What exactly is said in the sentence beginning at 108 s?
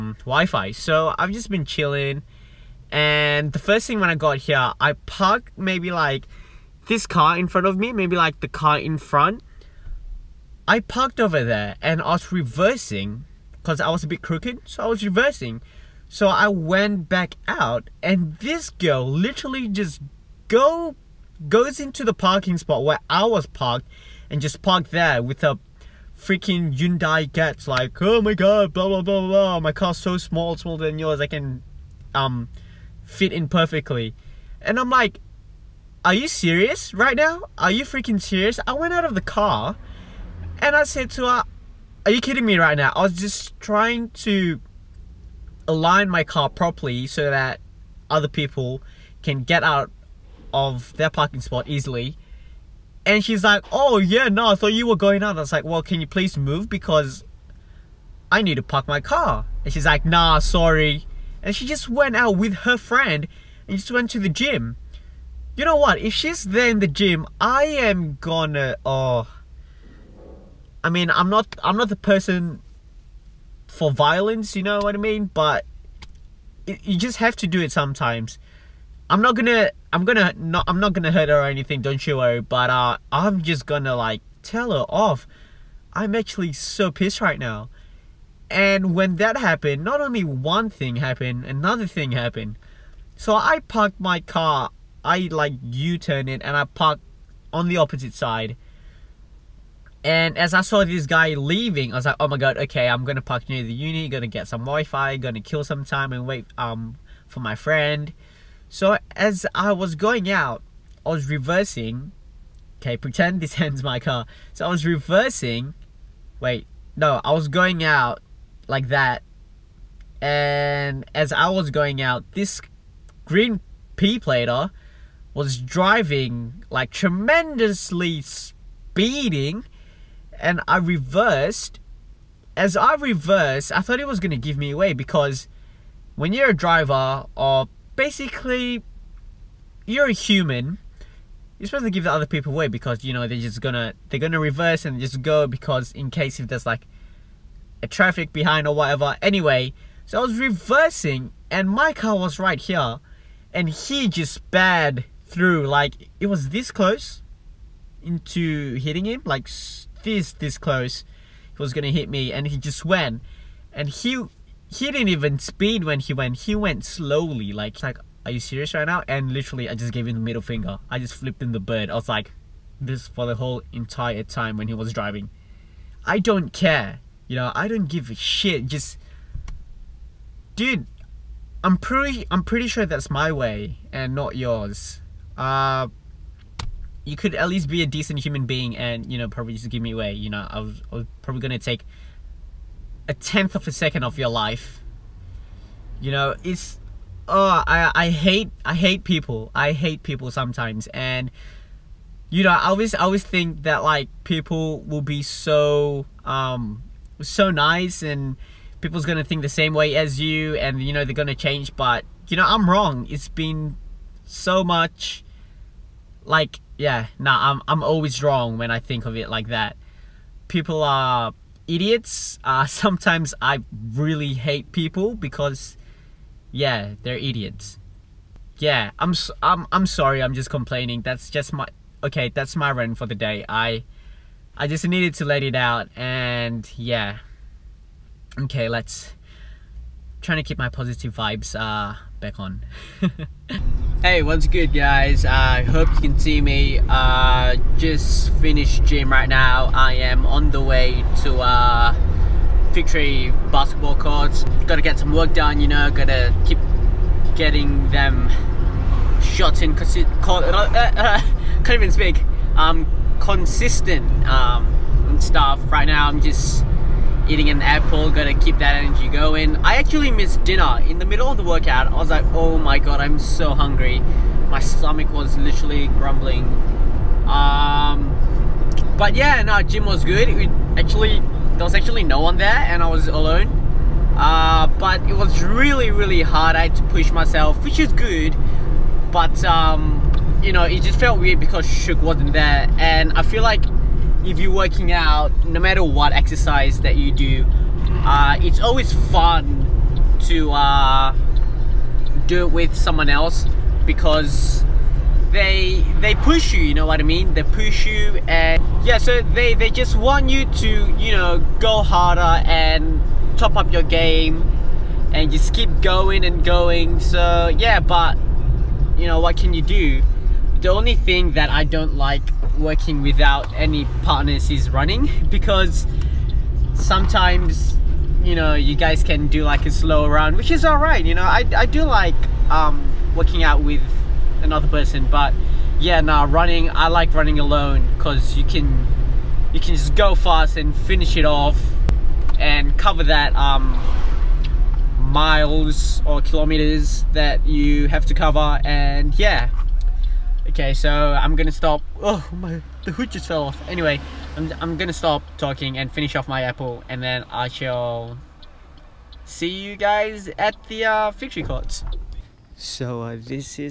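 So as I was going out, I was reversing.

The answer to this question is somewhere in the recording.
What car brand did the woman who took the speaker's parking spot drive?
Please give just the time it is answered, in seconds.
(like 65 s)
26 s.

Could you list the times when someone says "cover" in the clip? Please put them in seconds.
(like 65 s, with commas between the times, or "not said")
342 s, 348 s.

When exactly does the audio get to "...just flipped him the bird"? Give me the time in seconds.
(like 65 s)
170 s.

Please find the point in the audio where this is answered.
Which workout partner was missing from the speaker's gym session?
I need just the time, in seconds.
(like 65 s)
291 s.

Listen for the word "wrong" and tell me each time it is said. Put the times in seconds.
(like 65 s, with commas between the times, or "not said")
212 s, 218 s.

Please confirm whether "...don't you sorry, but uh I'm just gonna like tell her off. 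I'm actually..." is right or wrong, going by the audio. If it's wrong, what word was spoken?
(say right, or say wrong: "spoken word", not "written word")
wrong: "worry", not "sorry".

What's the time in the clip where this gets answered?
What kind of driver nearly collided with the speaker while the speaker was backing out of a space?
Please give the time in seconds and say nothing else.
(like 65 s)
123 s.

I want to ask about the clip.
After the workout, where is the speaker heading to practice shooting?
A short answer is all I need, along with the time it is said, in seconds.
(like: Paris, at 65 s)
Victory basketball courts, at 252 s.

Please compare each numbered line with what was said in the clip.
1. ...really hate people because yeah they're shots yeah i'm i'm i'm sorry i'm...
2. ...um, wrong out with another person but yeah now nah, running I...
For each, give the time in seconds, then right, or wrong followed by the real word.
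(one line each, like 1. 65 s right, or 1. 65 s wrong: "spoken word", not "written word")
1. 223 s wrong: "idiots", not "shots"
2. 332 s wrong: "working", not "wrong".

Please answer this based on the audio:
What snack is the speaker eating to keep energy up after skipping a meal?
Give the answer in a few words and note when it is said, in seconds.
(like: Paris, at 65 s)
an apple, at 267 s.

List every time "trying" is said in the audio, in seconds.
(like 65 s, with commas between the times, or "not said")
43 s, 240 s.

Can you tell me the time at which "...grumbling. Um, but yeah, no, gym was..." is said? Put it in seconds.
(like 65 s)
275 s.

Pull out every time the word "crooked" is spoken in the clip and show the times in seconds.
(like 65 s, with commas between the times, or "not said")
14 s.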